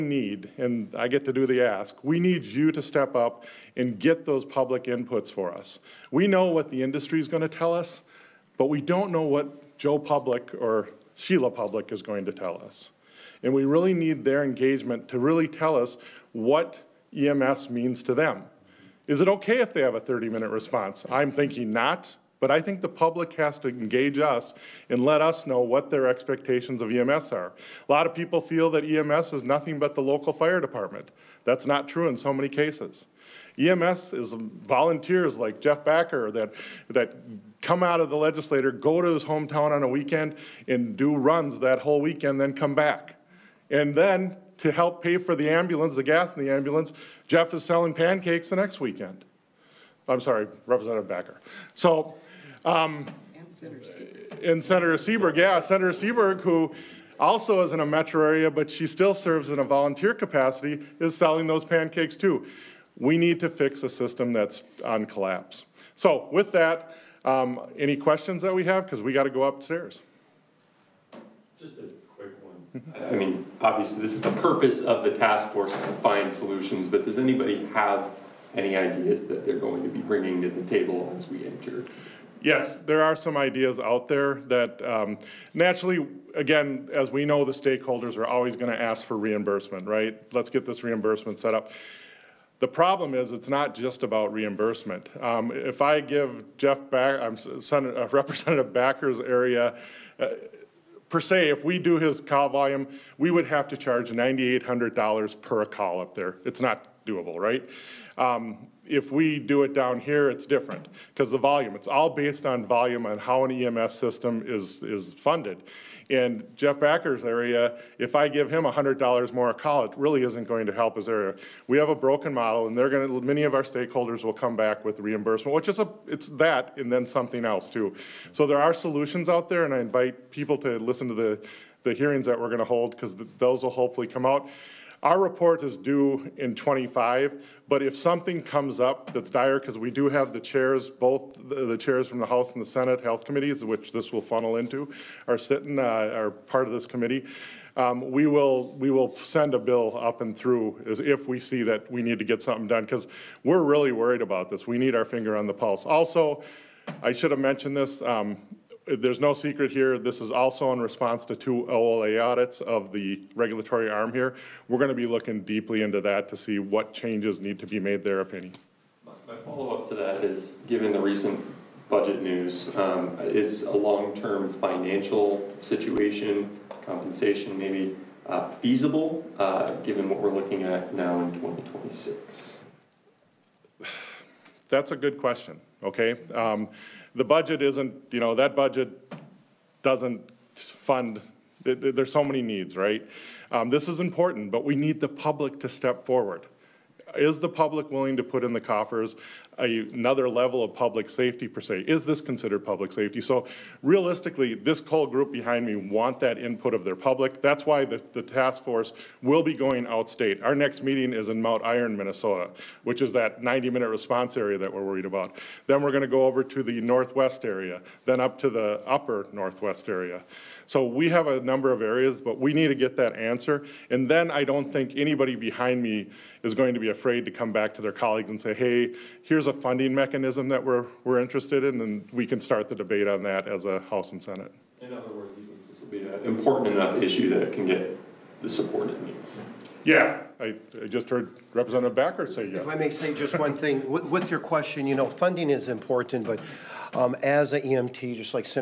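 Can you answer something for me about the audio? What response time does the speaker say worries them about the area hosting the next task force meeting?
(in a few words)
90 minutes.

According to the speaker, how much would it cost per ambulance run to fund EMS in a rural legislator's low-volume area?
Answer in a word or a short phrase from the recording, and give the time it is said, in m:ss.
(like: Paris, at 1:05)
$9,800, at 1:44.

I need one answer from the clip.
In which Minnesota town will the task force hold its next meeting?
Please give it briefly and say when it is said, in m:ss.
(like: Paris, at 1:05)
Mountain Iron, at 3:31.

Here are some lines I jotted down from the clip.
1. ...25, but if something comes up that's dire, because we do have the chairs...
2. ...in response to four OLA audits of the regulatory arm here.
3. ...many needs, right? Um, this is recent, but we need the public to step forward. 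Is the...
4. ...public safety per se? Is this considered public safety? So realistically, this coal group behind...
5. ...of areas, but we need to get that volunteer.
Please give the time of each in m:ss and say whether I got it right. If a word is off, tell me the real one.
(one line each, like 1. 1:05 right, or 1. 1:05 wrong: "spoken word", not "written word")
1. 2:16 right
2. 2:40 wrong: "two", not "four"
3. 3:12 wrong: "important", not "recent"
4. 3:20 right
5. 3:41 wrong: "answer", not "volunteer".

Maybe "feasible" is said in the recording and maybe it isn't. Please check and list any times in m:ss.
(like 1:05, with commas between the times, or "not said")
2:58.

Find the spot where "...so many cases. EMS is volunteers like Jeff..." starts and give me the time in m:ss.
0:32.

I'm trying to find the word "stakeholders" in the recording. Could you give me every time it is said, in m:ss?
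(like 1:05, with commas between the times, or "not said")
1:27, 2:03.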